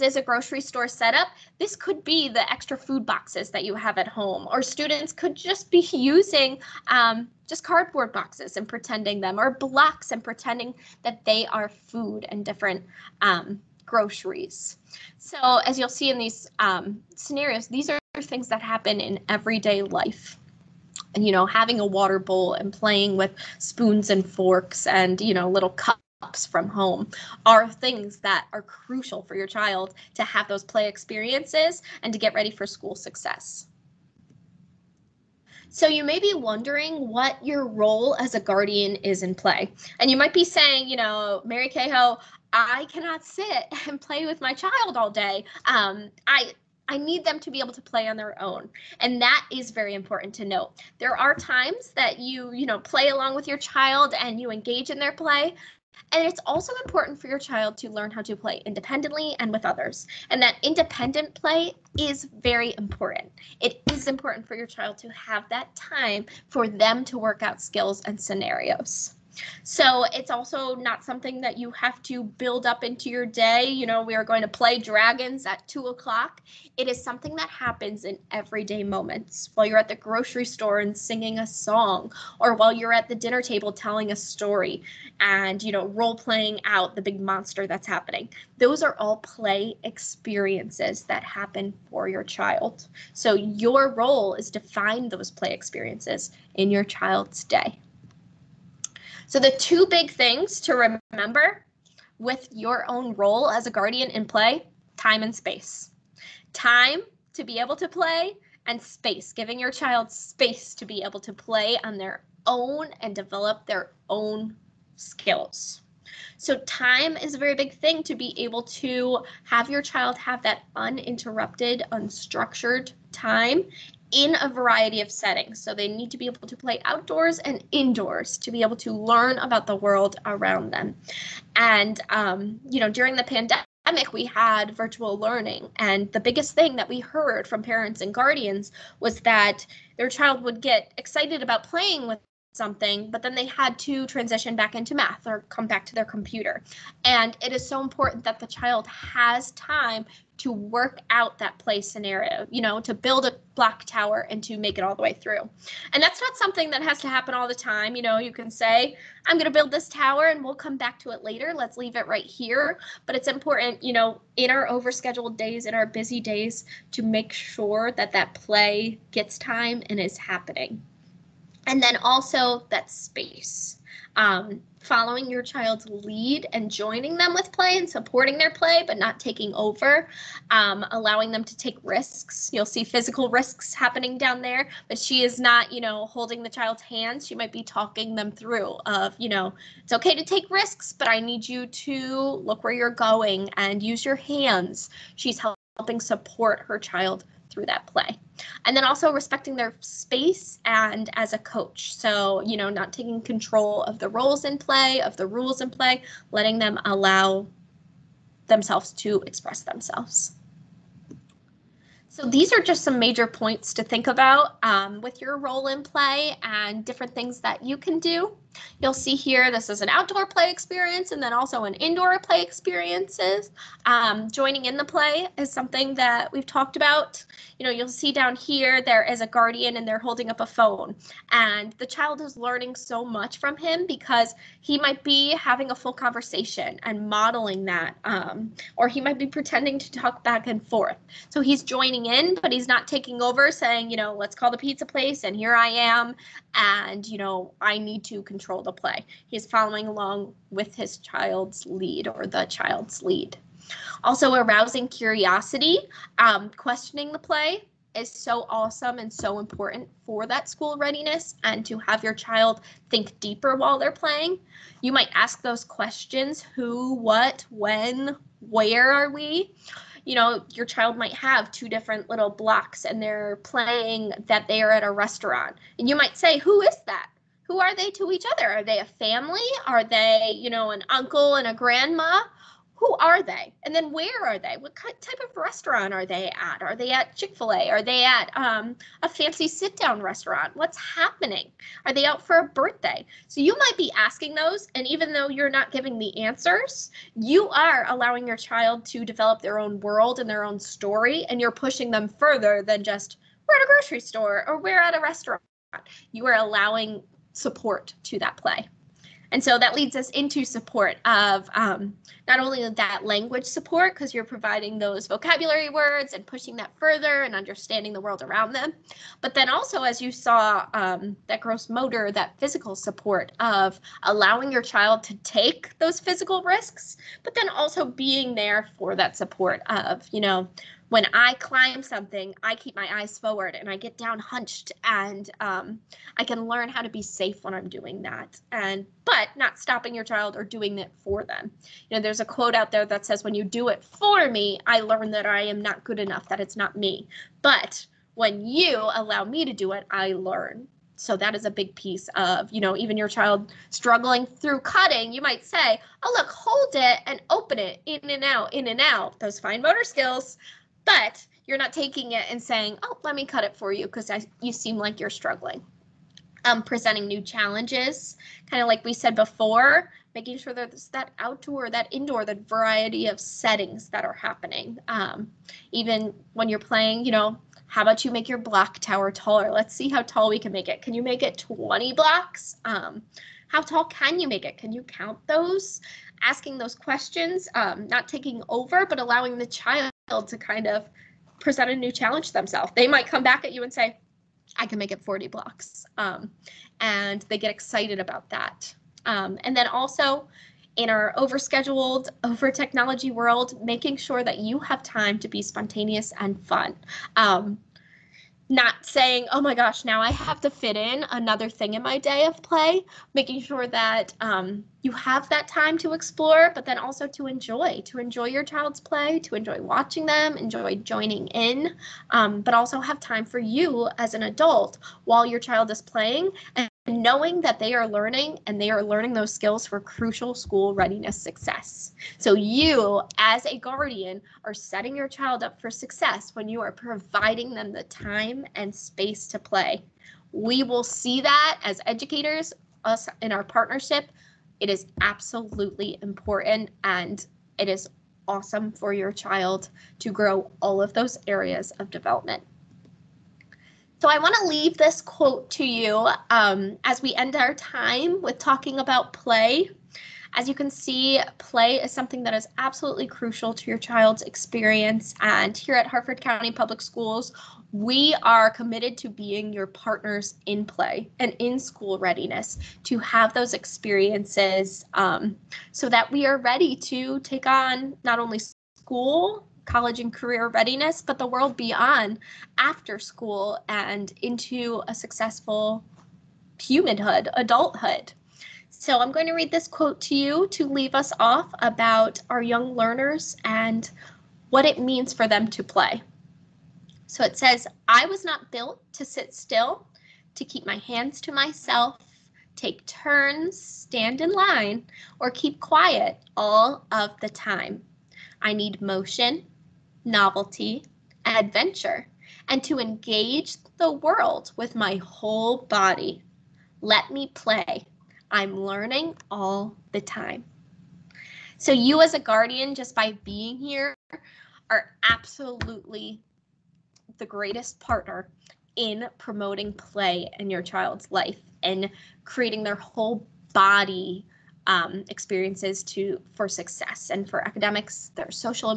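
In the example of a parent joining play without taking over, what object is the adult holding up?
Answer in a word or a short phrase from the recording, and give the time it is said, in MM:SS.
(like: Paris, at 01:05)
A phone, at 03:50.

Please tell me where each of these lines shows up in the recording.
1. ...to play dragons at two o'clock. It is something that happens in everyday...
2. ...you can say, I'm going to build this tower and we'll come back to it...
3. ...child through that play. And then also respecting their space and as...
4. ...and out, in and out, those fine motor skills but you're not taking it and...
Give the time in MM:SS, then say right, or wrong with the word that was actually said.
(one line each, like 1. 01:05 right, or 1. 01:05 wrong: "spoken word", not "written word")
1. 01:14 right
2. 02:38 right
3. 03:16 right
4. 05:58 right.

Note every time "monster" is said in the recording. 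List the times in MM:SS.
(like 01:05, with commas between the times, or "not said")
01:27.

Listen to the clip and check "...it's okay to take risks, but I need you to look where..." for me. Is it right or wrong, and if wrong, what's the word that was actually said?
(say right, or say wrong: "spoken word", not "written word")
right.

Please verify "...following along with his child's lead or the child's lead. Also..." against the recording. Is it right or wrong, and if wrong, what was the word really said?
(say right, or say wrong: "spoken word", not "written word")
right.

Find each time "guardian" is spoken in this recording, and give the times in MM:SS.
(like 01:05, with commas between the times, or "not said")
00:38, 01:43, 02:18, 03:49, 07:13, 08:42.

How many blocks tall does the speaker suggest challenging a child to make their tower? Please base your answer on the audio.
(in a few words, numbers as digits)
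20.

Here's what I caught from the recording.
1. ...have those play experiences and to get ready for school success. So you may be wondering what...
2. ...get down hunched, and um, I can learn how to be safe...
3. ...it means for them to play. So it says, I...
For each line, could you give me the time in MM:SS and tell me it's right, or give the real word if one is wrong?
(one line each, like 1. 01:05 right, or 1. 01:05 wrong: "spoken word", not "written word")
1. 00:30 right
2. 05:33 right
3. 08:14 right.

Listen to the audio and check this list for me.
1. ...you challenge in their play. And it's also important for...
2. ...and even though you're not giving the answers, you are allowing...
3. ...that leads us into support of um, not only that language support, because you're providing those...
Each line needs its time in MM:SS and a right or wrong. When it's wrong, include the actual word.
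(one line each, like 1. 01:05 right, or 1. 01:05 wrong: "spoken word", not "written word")
1. 00:54 wrong: "engage", not "challenge"
2. 04:54 right
3. 05:09 right.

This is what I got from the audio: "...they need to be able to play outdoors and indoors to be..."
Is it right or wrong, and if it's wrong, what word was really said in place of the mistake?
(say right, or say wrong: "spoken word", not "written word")
right.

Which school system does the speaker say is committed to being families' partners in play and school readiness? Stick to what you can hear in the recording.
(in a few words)
Harford County Public Schools.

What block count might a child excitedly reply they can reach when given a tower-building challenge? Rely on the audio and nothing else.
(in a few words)
40.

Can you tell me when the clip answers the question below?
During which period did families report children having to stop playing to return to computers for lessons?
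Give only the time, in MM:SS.
02:13.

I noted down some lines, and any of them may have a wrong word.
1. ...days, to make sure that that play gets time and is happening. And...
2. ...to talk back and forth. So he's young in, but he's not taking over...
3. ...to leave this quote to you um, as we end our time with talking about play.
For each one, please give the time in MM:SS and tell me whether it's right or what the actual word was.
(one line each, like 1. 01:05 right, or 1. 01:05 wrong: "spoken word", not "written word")
1. 02:46 right
2. 03:59 wrong: "joining", not "young"
3. 07:34 right.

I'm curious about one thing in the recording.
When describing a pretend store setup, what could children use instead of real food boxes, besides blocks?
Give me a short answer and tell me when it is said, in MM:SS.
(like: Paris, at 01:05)
Cardboard boxes, at 00:07.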